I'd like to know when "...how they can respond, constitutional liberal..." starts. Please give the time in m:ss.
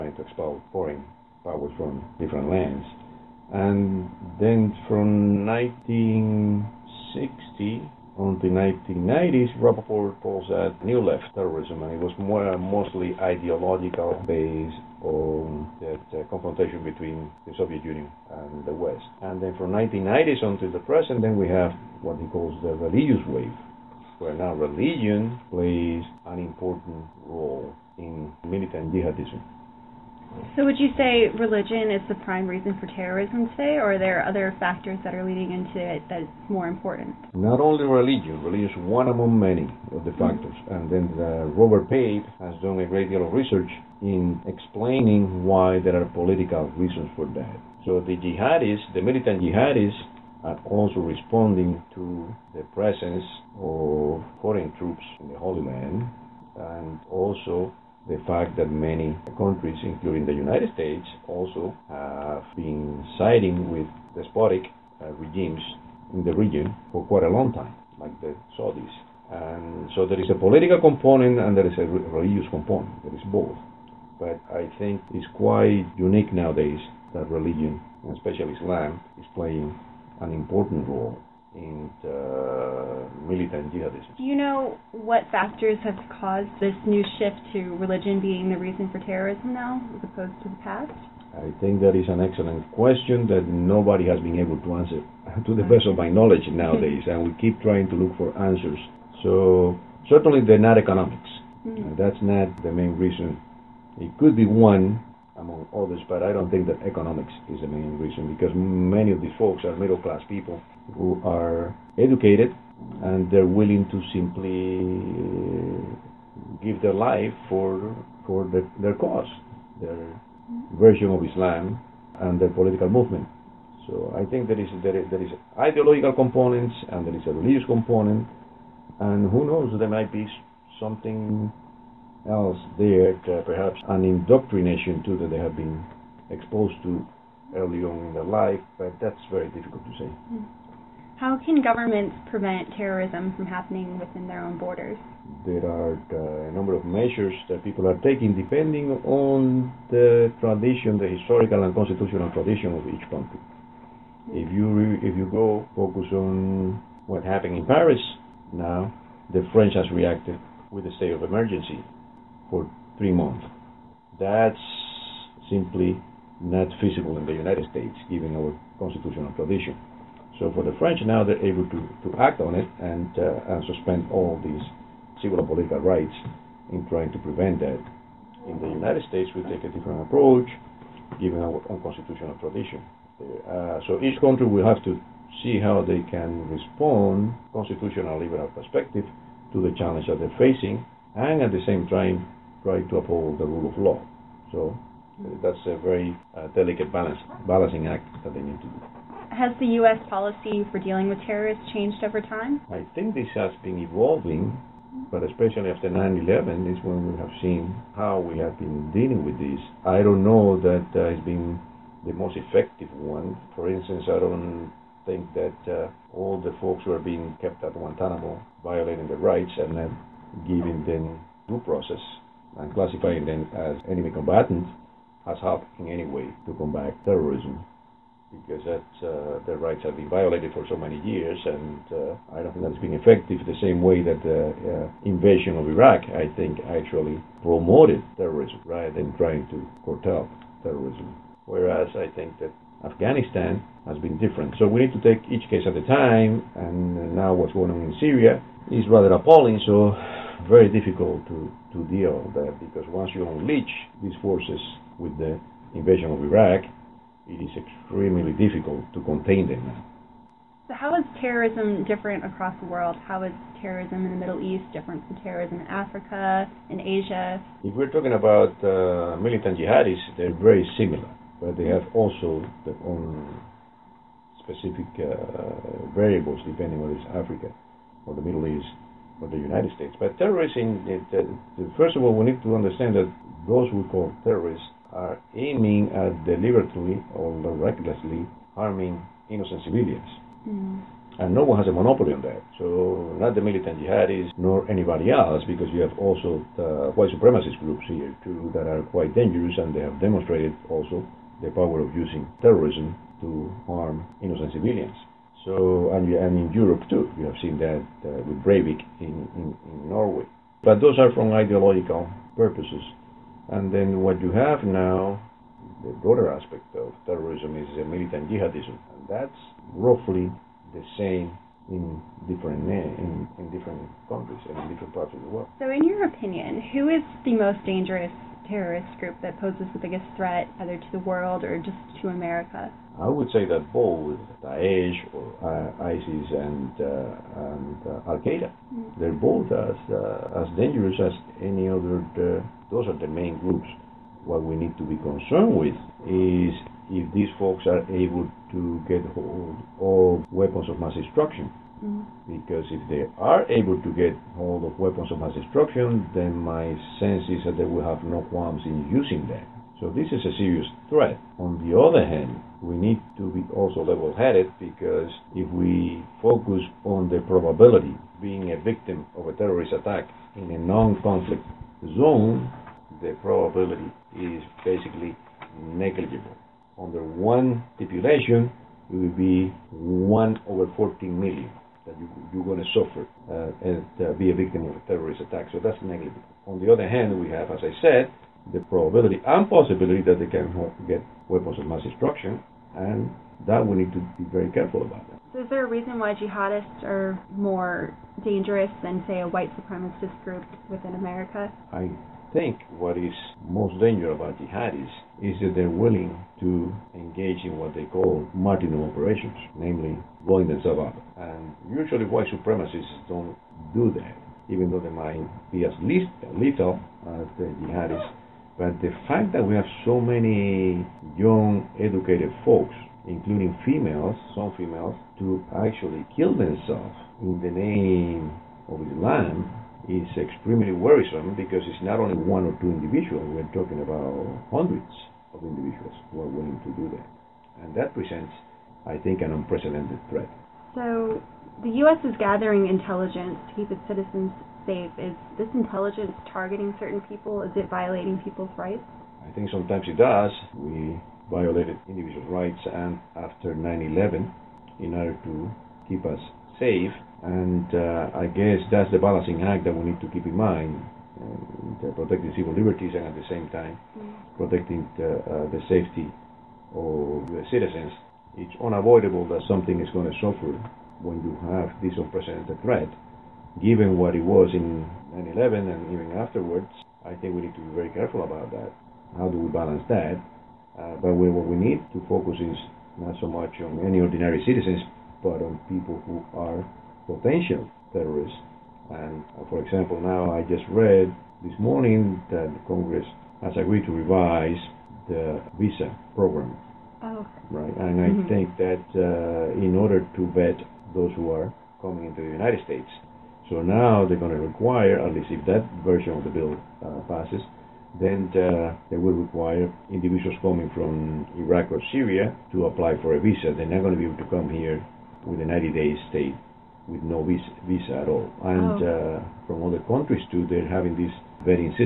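3:05.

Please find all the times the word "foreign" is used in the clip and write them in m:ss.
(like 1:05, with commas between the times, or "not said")
0:00, 0:54.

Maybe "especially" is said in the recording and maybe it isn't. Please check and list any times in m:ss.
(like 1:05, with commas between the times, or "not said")
1:18, 3:25.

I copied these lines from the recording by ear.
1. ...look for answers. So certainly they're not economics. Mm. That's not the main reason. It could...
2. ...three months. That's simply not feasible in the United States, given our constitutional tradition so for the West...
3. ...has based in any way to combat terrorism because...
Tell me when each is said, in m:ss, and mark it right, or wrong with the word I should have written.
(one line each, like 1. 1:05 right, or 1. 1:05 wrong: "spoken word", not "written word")
1. 1:37 right
2. 2:42 wrong: "French", not "West"
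3. 3:45 wrong: "helped", not "based".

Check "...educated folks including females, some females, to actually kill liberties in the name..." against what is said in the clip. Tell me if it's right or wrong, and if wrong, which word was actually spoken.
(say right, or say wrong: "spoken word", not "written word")
wrong: "themselves", not "liberties".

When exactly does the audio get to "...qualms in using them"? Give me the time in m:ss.
5:58.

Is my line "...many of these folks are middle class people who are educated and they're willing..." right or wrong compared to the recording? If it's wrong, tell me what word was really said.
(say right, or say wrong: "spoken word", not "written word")
right.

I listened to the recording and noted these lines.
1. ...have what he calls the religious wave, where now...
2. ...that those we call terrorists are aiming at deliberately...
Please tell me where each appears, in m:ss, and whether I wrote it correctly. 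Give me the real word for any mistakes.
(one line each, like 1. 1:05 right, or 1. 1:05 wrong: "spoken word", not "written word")
1. 0:21 right
2. 4:42 right.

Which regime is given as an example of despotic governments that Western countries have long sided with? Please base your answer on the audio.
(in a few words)
The Saudis.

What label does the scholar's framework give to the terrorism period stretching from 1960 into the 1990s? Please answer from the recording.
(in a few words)
New left terrorism.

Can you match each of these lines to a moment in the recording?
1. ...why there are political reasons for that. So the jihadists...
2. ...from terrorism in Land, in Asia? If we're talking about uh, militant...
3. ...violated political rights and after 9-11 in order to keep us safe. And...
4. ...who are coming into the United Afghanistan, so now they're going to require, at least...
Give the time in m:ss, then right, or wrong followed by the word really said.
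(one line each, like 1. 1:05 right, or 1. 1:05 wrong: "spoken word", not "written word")
1. 0:45 right
2. 4:25 wrong: "Africa", not "Land"
3. 7:31 wrong: "individual", not "political"
4. 8:21 wrong: "States", not "Afghanistan".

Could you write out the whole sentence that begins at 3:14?
So uh, that's a very uh, delicate balance, balancing act that they need to do has the U.S.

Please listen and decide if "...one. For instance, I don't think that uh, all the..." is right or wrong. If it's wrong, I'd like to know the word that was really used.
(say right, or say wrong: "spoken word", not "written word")
right.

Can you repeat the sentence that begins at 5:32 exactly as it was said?
I would say that both Daesh or uh, ISIS and, uh, and uh, Al Qaeda, mm-hmm.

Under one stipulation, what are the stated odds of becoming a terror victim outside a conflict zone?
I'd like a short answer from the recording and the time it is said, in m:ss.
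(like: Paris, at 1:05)
1 in 14 million, at 6:19.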